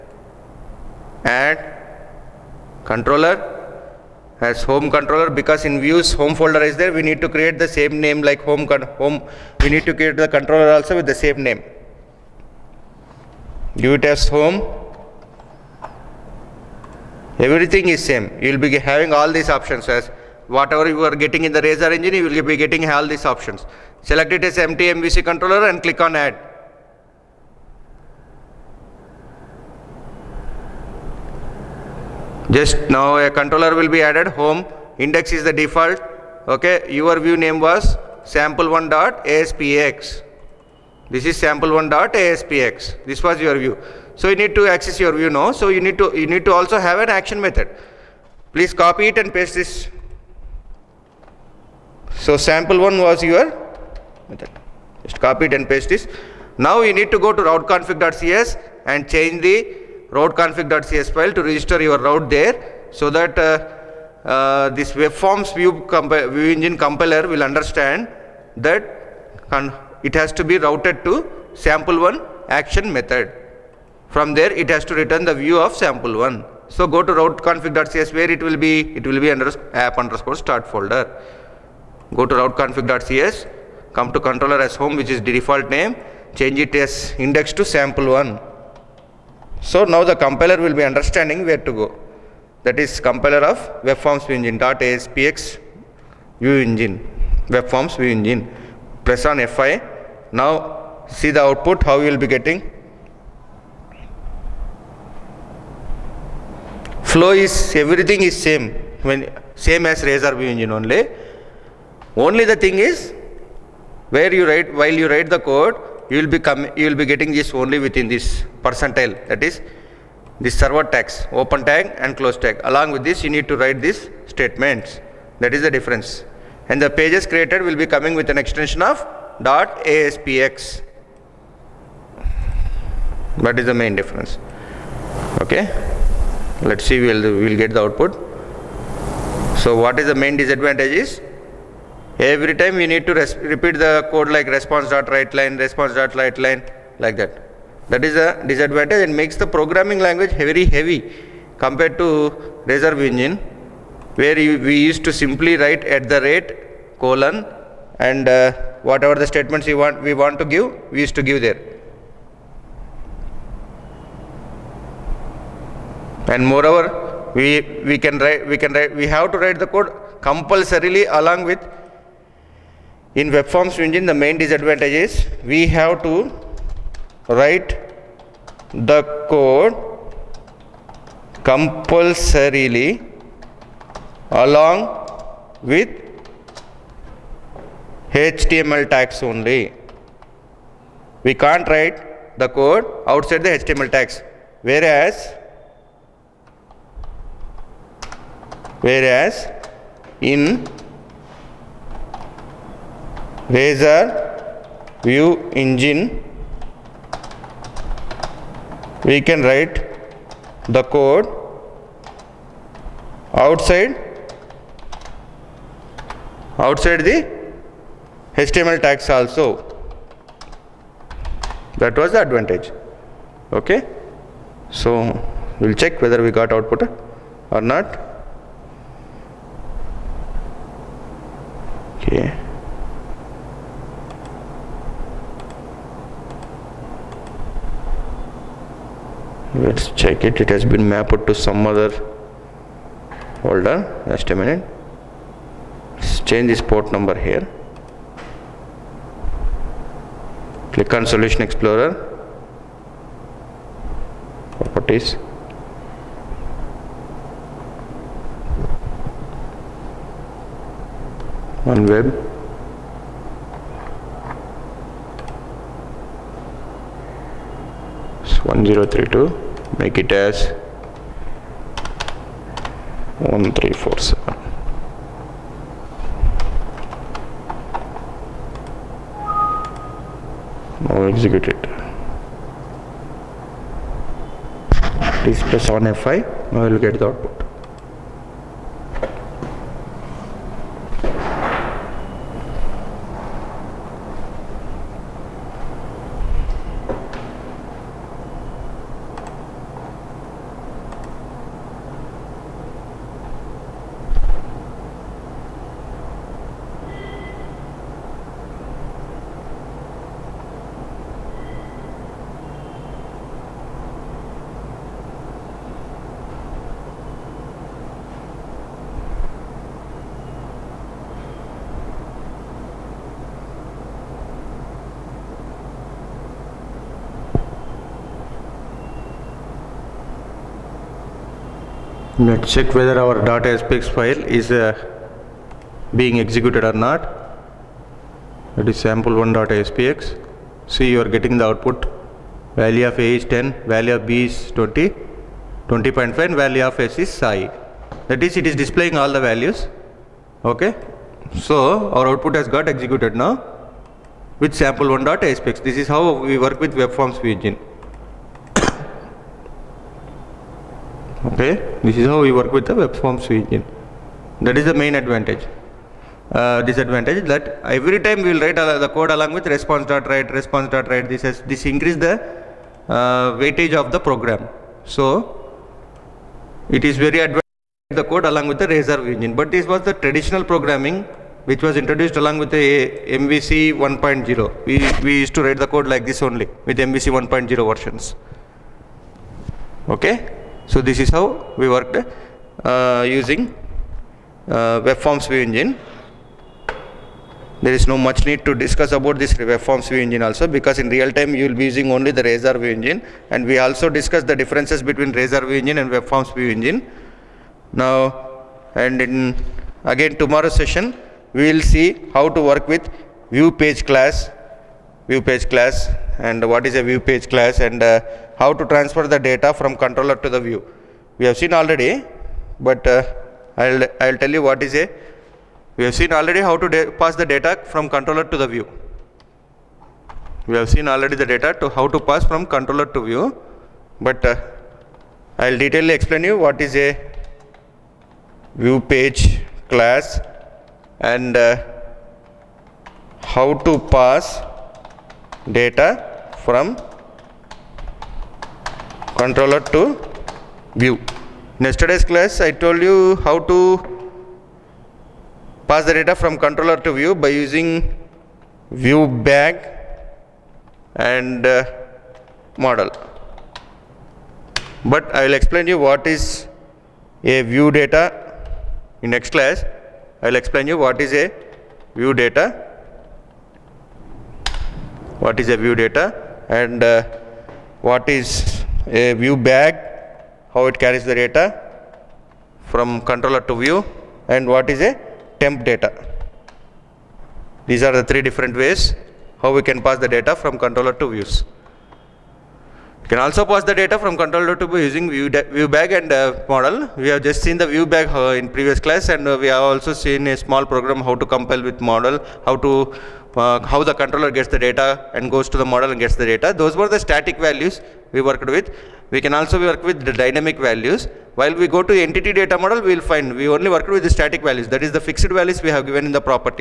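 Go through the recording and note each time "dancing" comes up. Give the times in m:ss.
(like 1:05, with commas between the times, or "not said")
not said.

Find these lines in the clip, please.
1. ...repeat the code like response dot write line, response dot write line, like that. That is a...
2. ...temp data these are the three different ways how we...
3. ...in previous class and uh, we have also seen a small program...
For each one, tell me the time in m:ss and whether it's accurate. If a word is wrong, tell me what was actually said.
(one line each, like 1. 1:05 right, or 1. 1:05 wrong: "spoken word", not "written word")
1. 2:23 right
2. 8:05 right
3. 8:18 right.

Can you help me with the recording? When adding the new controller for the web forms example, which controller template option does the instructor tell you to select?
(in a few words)
Empty MVC controller.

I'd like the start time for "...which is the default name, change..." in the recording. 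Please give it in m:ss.
1:24.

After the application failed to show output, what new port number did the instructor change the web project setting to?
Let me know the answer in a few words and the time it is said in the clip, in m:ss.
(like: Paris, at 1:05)
1347, at 4:33.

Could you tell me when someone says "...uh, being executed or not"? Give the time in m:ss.
5:34.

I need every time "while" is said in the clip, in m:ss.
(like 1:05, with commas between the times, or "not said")
1:54, 8:31.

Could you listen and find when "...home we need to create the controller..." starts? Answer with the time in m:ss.
0:09.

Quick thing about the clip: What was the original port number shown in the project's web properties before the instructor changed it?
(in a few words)
1032.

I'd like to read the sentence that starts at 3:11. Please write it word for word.
We can't write the code outside the HTML tags.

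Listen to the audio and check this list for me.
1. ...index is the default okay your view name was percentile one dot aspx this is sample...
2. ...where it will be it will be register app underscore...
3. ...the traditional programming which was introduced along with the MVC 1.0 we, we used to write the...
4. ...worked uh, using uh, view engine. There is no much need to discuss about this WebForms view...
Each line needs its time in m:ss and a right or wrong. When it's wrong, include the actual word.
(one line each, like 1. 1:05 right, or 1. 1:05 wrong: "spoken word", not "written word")
1. 0:35 wrong: "sample", not "percentile"
2. 1:18 wrong: "under", not "register"
3. 6:19 right
4. 6:31 right.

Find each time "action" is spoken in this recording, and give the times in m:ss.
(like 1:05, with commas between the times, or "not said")
0:47, 1:12.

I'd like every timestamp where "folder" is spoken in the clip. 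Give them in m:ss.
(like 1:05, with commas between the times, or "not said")
0:06, 1:20, 4:03.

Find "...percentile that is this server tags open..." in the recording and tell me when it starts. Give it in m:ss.
1:58.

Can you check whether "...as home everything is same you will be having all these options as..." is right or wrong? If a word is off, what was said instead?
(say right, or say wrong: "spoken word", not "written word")
right.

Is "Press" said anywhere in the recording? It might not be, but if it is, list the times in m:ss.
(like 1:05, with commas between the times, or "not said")
1:39.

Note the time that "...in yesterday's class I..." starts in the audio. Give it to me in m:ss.
7:31.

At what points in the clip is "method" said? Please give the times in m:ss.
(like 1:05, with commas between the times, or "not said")
0:47, 0:54, 1:12.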